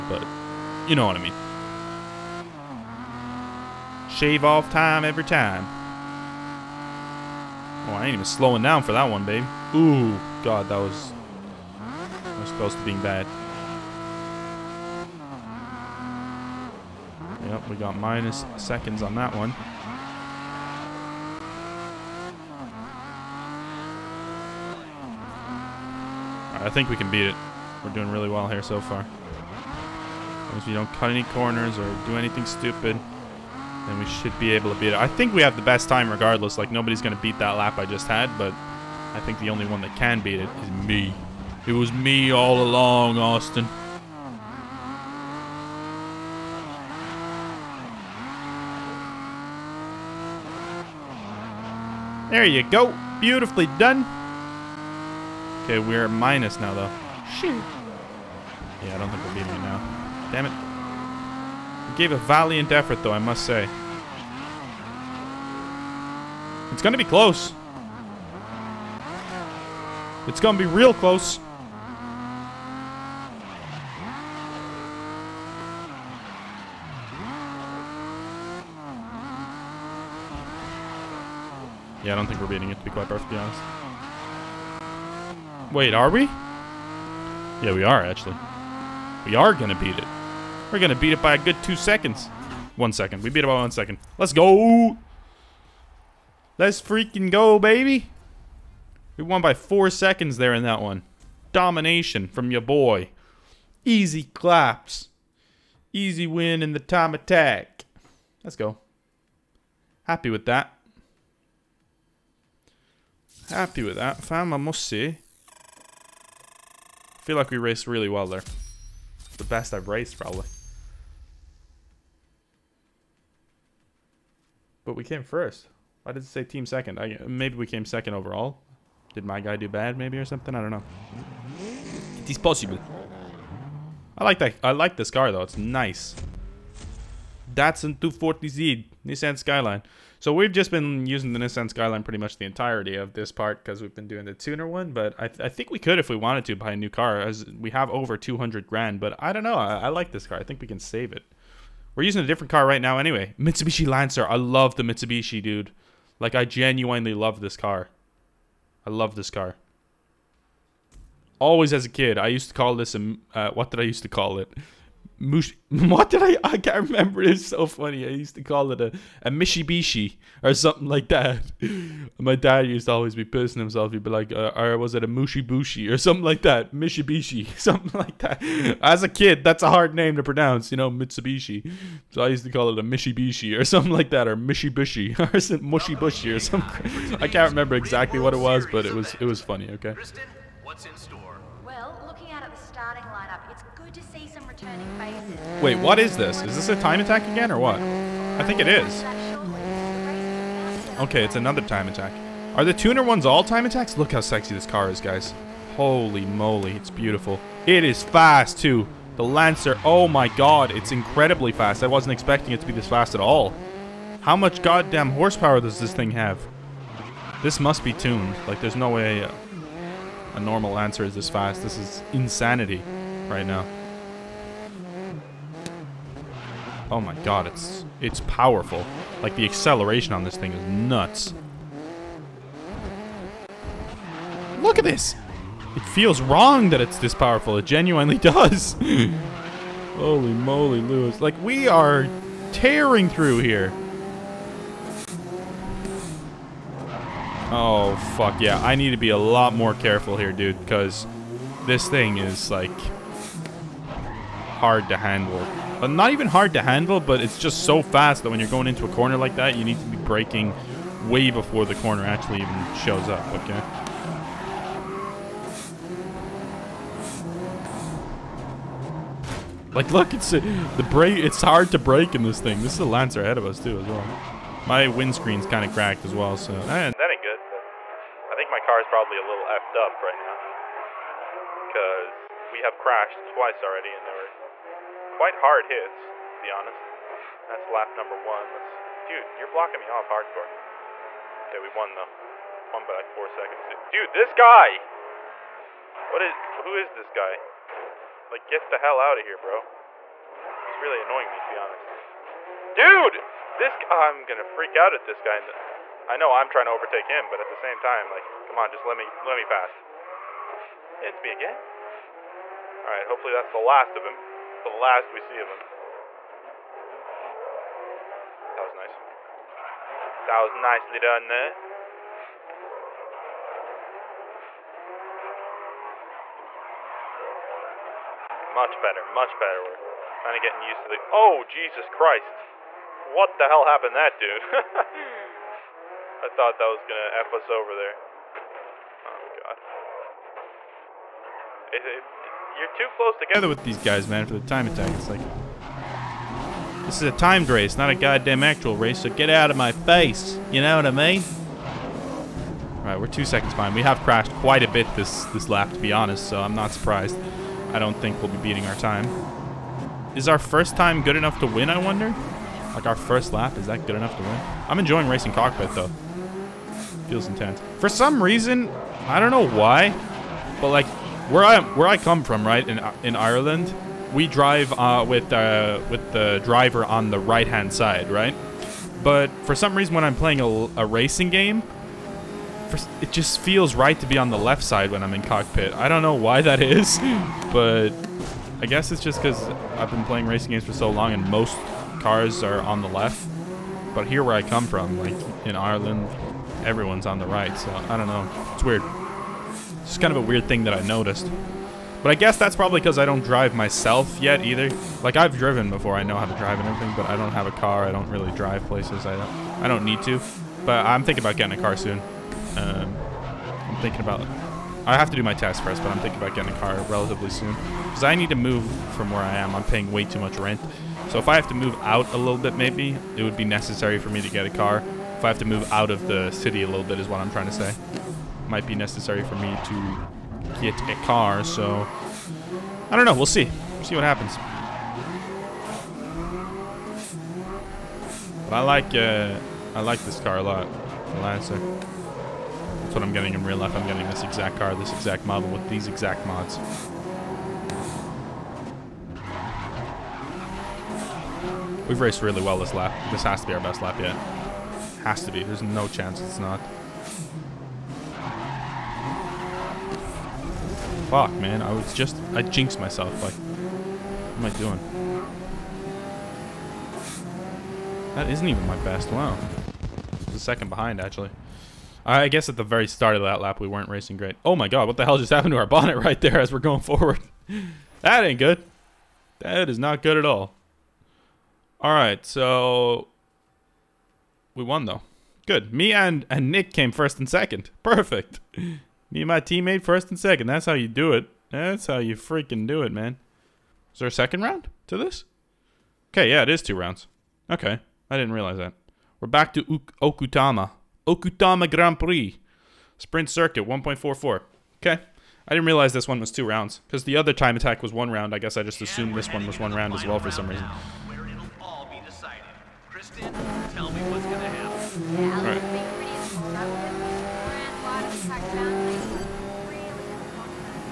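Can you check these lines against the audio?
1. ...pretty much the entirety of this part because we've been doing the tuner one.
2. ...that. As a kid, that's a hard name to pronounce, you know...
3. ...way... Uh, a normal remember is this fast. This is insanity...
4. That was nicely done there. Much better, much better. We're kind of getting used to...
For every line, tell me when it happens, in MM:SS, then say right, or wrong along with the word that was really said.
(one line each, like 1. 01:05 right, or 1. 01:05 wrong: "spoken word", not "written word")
1. 02:22 right
2. 02:58 right
3. 03:38 wrong: "answer", not "remember"
4. 05:20 right.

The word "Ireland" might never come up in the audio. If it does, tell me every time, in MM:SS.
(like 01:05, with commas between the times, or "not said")
06:13, 06:35.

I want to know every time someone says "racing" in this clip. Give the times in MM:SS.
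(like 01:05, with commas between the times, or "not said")
06:05, 06:20, 06:30, 07:53.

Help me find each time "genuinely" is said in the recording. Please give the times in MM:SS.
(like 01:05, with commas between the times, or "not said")
02:36, 03:57.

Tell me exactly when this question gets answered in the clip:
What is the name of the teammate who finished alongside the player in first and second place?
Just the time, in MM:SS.
08:06.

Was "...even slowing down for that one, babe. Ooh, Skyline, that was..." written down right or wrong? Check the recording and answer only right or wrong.
wrong.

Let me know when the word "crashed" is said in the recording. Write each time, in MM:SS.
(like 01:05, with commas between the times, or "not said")
04:42, 05:53.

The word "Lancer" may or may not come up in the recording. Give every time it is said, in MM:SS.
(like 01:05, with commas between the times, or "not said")
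02:33, 03:29, 04:32, 07:21.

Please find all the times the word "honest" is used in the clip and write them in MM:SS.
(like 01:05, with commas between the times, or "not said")
01:23, 04:46, 05:01, 05:55.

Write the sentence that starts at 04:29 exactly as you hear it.
Like, look, it's uh, the brake.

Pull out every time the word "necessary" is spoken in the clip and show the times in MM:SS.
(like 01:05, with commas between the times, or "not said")
07:03, 07:08.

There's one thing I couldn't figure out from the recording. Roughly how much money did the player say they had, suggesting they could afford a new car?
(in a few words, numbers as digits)
over 200 grand.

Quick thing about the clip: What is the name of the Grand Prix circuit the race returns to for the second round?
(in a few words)
Okutama.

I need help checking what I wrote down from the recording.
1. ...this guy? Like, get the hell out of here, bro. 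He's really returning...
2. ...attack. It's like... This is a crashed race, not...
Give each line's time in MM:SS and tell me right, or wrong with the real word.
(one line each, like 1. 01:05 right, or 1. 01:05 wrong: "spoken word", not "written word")
1. 04:56 wrong: "annoying", not "returning"
2. 05:44 wrong: "timed", not "crashed".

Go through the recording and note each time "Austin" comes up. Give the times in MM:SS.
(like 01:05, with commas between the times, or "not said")
00:43.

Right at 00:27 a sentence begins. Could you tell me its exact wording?
We're doing really well here so far.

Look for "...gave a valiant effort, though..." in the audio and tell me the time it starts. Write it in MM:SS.
01:01.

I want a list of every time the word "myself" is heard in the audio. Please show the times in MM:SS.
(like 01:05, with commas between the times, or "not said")
06:43, 07:42.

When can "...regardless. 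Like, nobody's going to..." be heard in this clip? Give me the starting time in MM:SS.
00:36.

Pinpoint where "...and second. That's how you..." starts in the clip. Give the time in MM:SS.
08:10.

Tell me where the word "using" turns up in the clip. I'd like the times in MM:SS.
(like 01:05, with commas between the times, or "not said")
02:21, 02:32.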